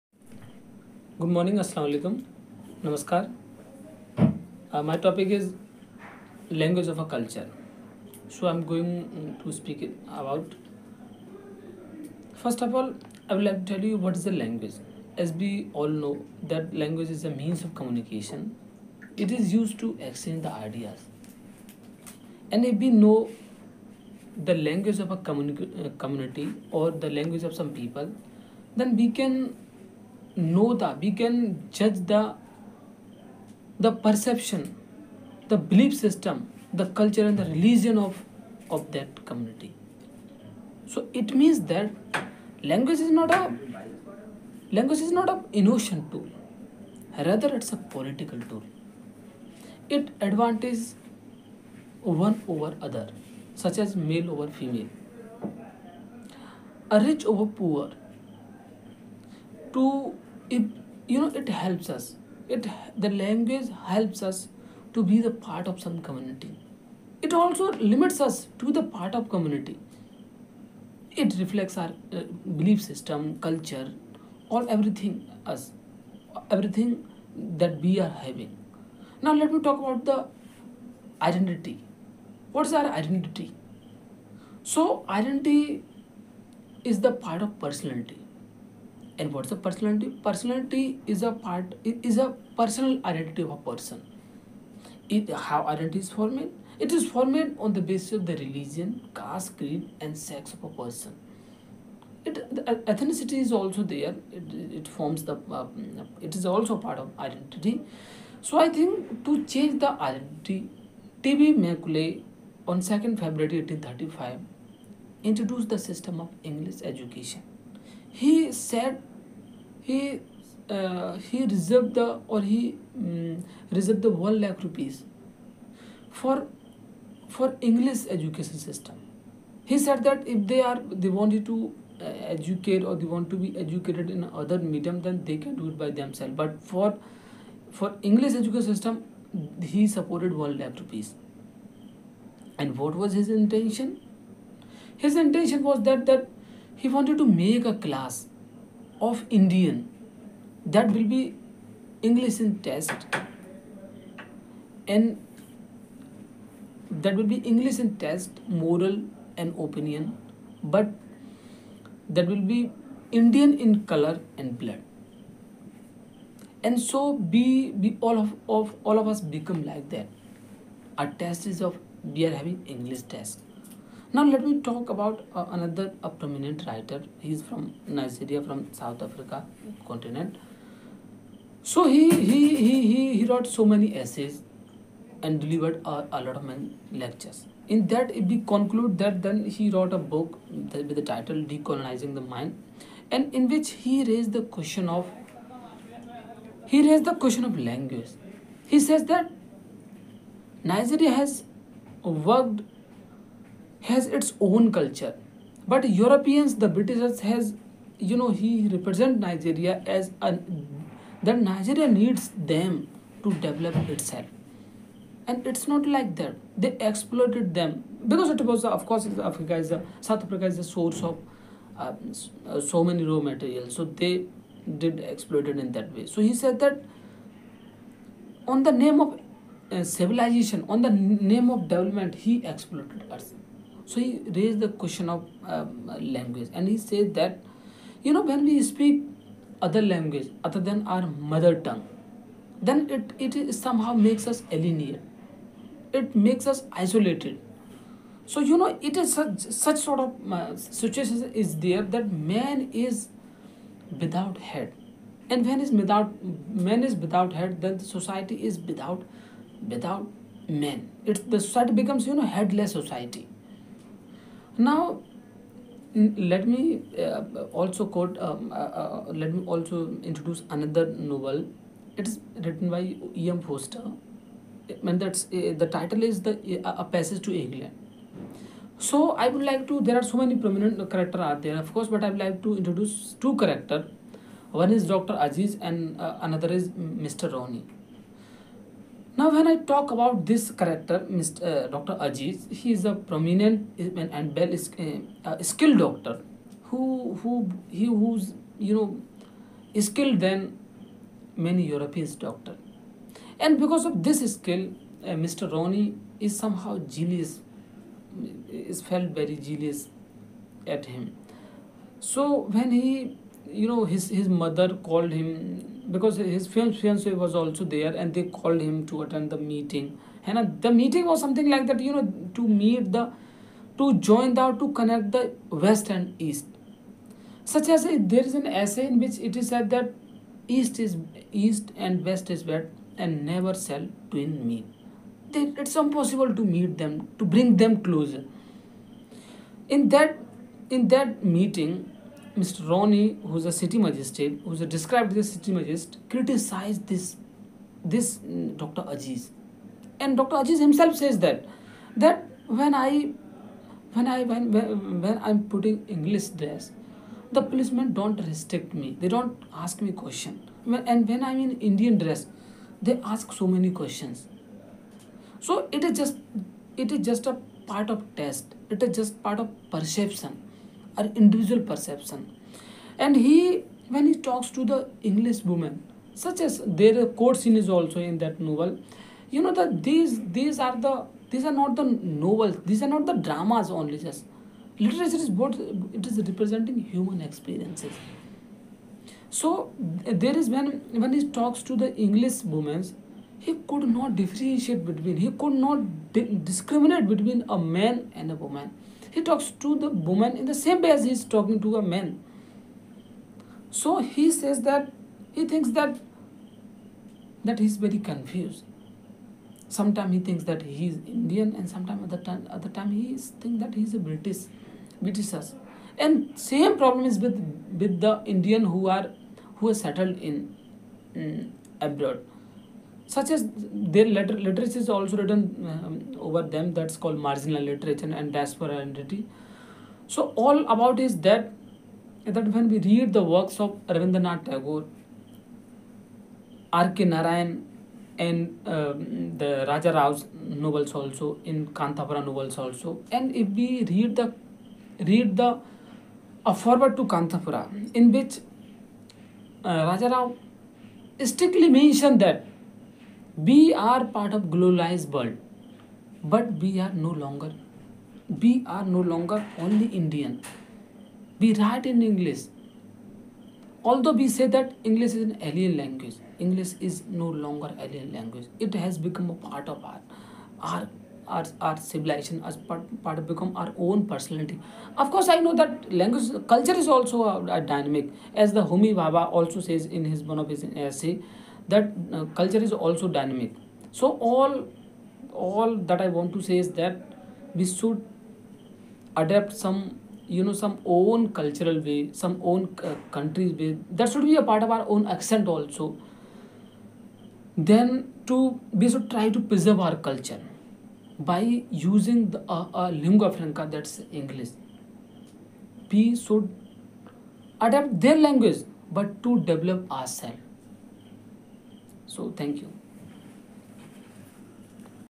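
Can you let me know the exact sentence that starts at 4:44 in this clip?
One is Doctor Aziz, and uh, another is Mr.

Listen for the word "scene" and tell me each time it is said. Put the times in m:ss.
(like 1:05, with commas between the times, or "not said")
6:17.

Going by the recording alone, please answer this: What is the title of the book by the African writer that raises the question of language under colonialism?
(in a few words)
Decolonizing the Mind.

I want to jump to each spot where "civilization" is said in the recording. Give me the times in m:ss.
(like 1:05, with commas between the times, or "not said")
3:49, 7:51.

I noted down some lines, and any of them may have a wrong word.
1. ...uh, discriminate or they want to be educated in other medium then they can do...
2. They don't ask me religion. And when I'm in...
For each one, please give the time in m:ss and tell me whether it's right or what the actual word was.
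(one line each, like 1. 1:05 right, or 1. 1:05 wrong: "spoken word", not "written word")
1. 2:12 wrong: "educate", not "discriminate"
2. 5:59 wrong: "question", not "religion".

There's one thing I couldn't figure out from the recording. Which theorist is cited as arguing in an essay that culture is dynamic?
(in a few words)
Homi Bhabha.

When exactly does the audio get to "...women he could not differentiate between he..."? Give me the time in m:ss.
6:32.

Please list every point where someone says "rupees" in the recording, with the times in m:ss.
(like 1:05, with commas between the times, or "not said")
2:04, 2:20.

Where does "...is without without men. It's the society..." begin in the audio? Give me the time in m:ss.
4:18.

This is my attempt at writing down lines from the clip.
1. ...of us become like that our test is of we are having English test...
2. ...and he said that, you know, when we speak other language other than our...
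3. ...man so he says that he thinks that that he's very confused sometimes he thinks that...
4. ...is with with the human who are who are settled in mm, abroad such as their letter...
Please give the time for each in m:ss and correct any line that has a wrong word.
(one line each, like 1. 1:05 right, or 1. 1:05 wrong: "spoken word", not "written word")
1. 2:48 right
2. 3:56 right
3. 6:41 right
4. 6:57 wrong: "indian", not "human".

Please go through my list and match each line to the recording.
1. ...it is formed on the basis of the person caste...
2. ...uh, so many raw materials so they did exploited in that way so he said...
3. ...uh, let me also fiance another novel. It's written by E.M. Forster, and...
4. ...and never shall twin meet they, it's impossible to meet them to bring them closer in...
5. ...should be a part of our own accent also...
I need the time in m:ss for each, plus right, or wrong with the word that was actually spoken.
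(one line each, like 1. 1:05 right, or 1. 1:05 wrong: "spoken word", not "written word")
1. 1:36 wrong: "religion", not "person"
2. 3:42 right
3. 4:28 wrong: "introduce", not "fiance"
4. 5:32 right
5. 8:14 right.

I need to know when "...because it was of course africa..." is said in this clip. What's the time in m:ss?
3:38.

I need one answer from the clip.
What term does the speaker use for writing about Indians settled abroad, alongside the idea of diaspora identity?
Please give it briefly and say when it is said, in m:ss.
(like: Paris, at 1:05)
Marginal literature, at 7:07.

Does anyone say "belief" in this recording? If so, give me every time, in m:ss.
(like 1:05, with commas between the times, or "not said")
0:35, 1:12.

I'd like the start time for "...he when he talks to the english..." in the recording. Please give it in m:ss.
6:13.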